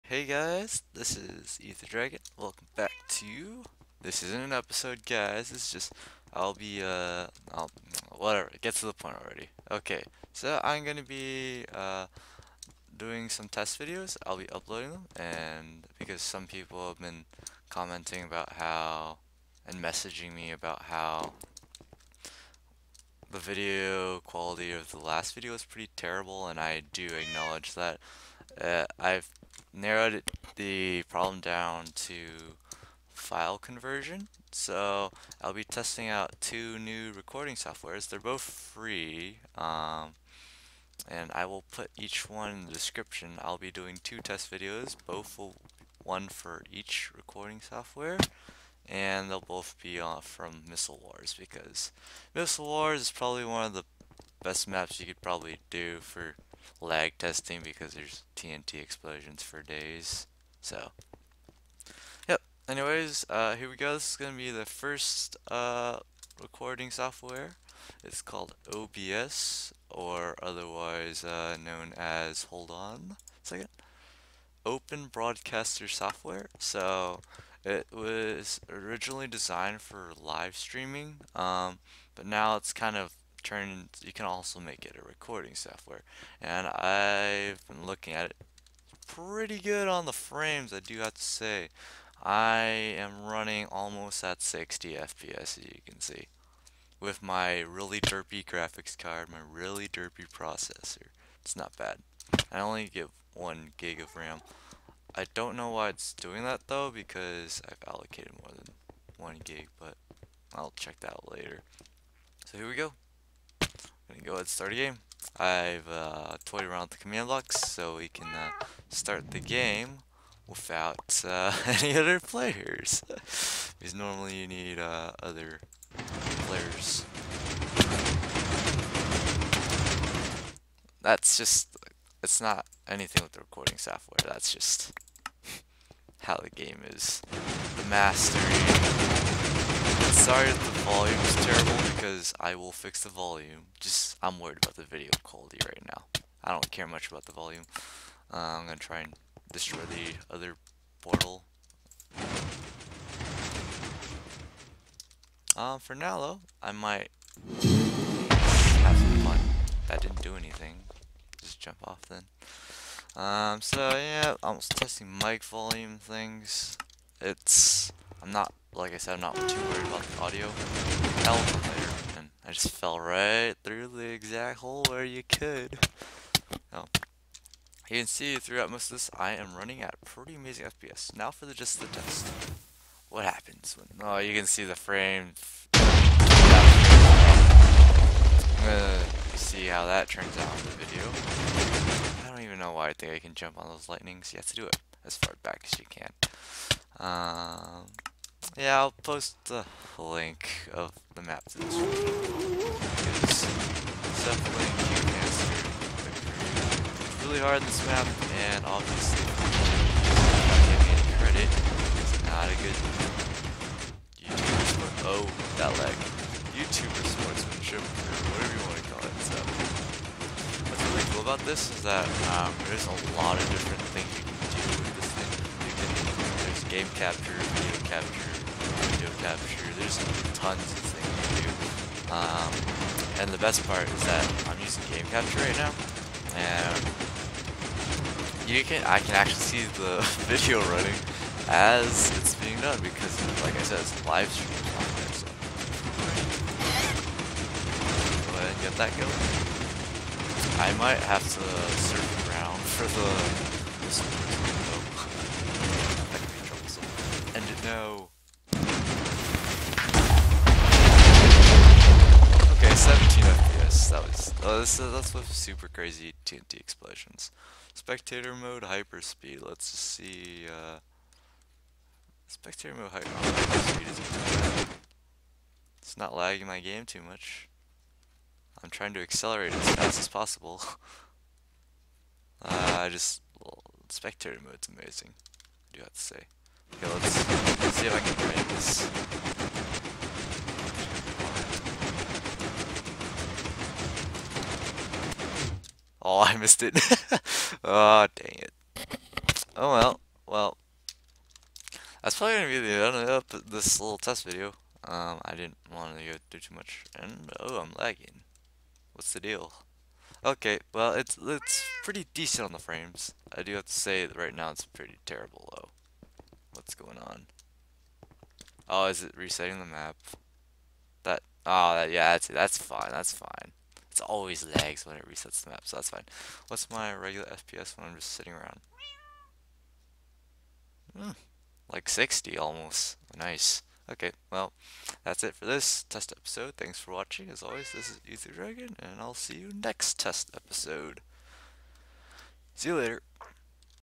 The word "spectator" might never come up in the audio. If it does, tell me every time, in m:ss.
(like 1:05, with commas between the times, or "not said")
4:27, 4:32, 4:43.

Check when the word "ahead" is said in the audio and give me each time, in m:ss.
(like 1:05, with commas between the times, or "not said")
1:54, 4:08.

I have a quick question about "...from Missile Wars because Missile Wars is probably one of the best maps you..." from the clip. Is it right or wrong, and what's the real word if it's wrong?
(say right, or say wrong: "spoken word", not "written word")
right.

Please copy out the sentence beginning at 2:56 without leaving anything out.
Now You can see throughout most of this, I am running at pretty amazing FPS.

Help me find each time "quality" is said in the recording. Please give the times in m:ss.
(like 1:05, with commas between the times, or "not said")
0:24, 2:25.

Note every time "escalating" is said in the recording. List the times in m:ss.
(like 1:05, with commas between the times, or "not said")
not said.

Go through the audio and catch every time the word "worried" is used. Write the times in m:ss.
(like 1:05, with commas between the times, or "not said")
2:24, 2:49.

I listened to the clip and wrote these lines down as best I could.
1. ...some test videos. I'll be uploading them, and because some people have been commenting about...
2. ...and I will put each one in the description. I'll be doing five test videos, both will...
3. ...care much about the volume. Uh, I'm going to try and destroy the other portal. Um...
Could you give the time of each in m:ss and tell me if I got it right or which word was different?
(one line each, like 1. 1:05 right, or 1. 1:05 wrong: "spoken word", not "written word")
1. 0:13 right
2. 0:41 wrong: "two", not "five"
3. 2:26 right.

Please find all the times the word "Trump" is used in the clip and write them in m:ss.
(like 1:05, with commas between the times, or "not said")
not said.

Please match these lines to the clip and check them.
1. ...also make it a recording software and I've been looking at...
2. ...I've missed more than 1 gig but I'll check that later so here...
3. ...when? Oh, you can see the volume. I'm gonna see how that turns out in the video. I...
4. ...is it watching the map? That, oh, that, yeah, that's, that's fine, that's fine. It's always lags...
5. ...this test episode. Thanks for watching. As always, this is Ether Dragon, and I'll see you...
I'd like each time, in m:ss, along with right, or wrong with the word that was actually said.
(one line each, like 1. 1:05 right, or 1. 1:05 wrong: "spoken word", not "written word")
1. 1:24 right
2. 1:47 wrong: "allocated", not "missed"
3. 3:03 wrong: "frame", not "volume"
4. 5:18 wrong: "resetting", not "watching"
5. 5:35 right.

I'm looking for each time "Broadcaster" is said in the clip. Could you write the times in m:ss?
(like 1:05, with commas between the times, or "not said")
1:15.